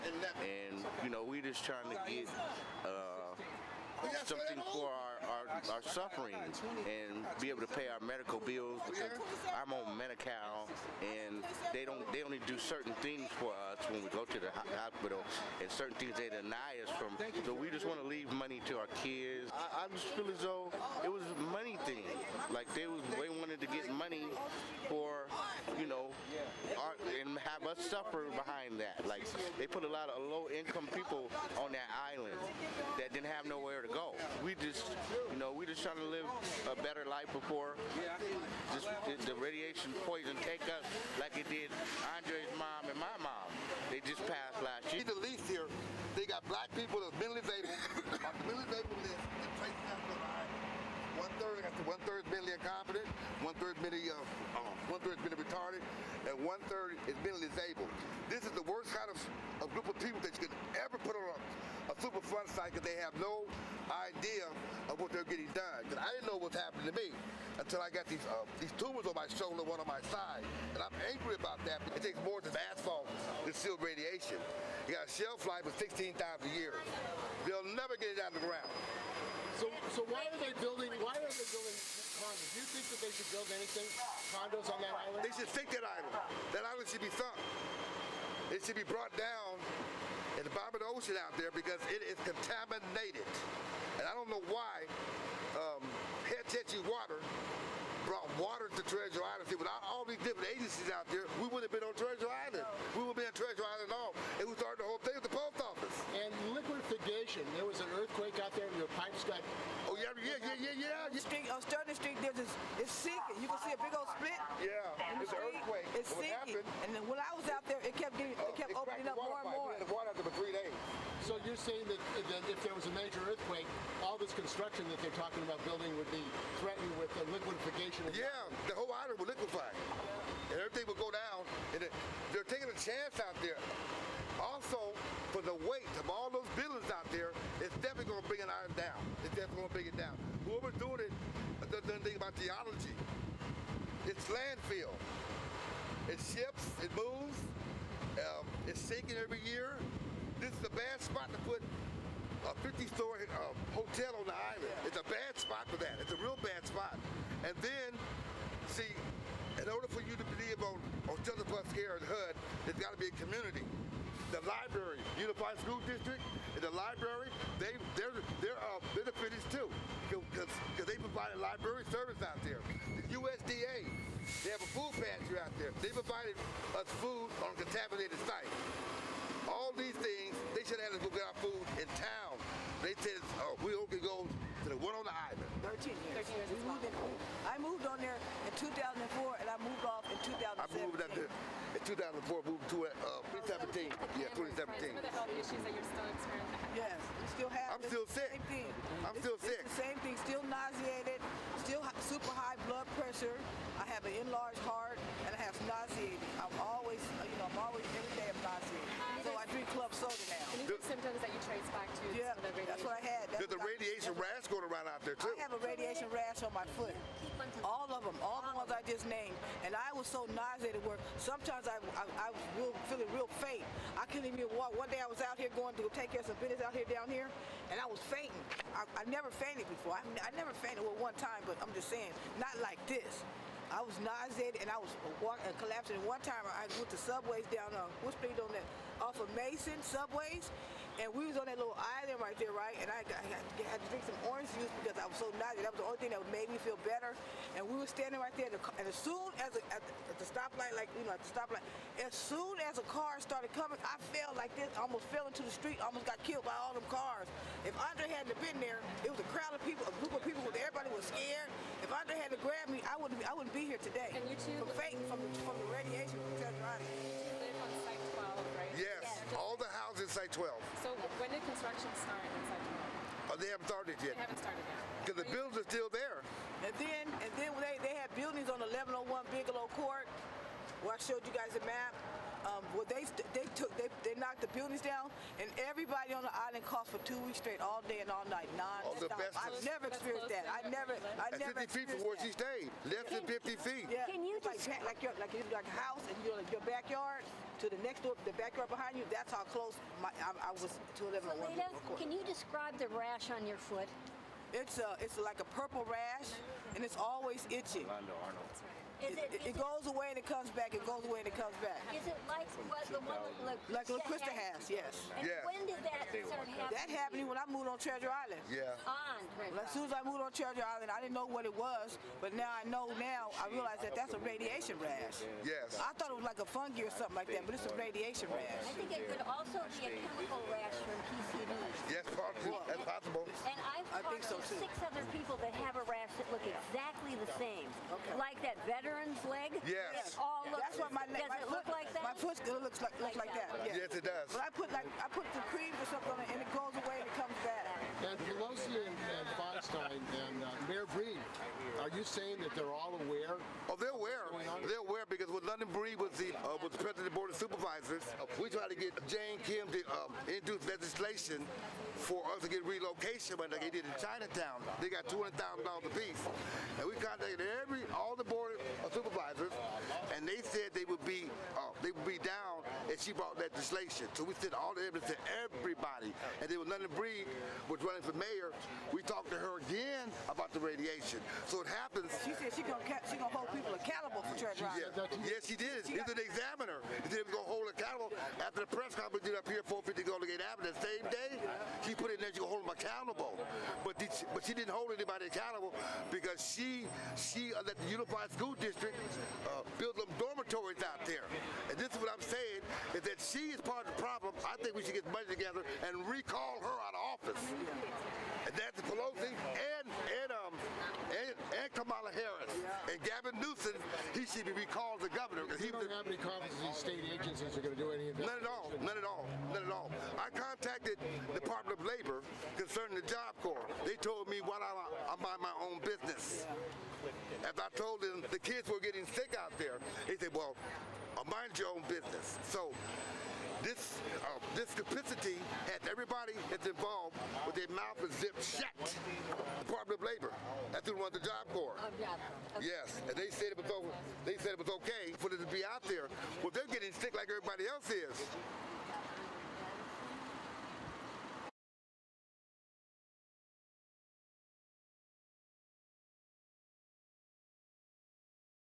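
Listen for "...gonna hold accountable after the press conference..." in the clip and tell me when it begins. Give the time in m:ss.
6:27.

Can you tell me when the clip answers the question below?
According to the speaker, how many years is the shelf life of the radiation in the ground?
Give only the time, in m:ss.
1:15.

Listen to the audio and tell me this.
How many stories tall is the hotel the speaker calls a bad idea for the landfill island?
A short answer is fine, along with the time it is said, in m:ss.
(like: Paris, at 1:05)
50, at 2:32.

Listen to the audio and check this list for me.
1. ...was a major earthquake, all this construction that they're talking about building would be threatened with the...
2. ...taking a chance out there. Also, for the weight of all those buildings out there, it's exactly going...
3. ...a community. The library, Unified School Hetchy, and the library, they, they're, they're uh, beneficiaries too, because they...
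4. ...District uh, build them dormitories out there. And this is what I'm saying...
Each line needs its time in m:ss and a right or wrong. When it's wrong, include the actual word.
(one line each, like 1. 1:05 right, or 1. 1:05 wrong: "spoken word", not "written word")
1. 2:02 right
2. 2:12 wrong: "definitely", not "exactly"
3. 2:43 wrong: "District", not "Hetchy"
4. 6:38 right.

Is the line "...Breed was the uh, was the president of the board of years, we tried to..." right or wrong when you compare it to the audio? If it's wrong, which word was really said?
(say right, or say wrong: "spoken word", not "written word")
wrong: "supervisors", not "years".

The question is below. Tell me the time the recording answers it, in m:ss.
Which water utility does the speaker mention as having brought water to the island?
1:36.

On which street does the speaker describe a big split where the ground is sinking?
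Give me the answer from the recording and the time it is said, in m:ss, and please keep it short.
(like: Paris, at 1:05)
Sterling Street, at 1:51.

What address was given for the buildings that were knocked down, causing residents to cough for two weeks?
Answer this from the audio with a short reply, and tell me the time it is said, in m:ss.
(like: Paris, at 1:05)
1101 Bigelow Court, at 4:38.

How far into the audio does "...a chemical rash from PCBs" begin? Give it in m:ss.
5:29.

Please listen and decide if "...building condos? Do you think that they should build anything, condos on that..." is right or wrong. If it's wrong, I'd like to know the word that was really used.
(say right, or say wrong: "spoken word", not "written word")
right.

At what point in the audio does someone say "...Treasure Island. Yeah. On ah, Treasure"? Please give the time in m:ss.
5:17.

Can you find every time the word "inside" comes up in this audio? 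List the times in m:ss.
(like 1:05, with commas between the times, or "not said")
4:32.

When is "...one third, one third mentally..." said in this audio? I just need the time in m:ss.
0:51.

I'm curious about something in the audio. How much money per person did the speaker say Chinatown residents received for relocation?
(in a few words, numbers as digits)
$200,000.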